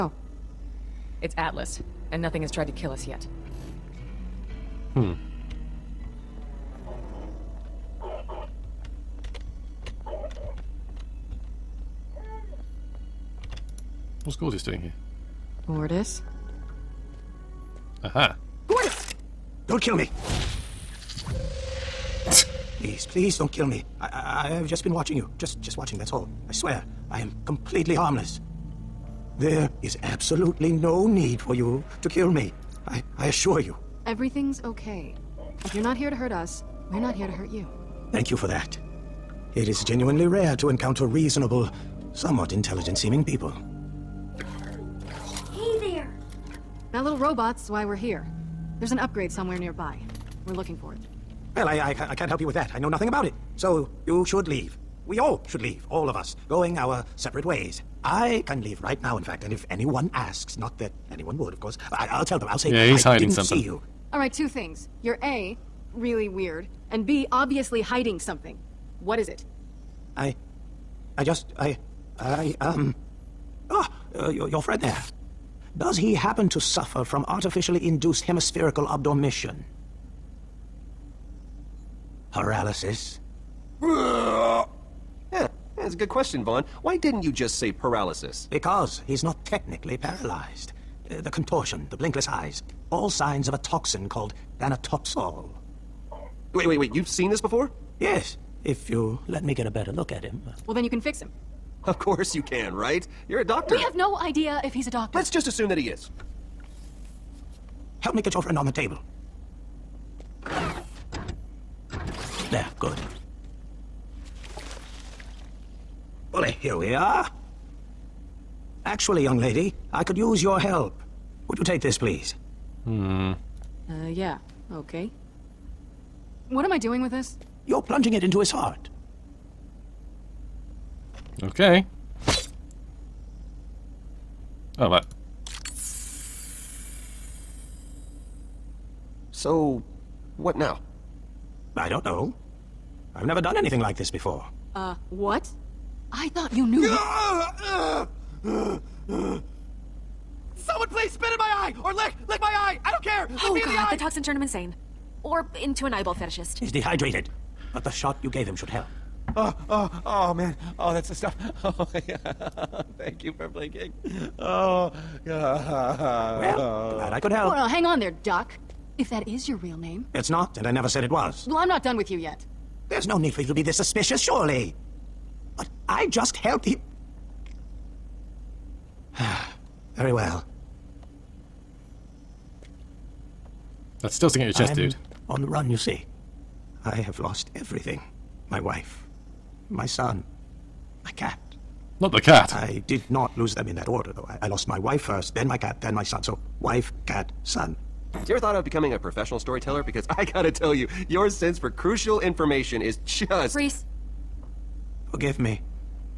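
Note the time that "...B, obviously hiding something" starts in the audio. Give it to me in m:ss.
1:07.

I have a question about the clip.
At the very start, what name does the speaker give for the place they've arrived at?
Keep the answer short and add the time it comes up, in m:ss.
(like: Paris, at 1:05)
Atlas, at 0:01.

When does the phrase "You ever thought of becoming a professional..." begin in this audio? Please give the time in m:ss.
3:18.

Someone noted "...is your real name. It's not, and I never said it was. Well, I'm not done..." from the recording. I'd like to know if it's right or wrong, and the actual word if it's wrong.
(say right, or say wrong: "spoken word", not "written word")
right.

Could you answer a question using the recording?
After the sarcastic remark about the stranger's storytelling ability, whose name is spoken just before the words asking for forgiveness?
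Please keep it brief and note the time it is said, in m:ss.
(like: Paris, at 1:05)
Rhys, at 3:23.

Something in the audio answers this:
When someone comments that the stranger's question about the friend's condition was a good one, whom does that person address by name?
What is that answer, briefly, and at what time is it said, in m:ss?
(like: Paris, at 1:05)
Vaughn, at 1:26.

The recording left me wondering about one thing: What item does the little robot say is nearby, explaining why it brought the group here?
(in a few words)
An upgrade.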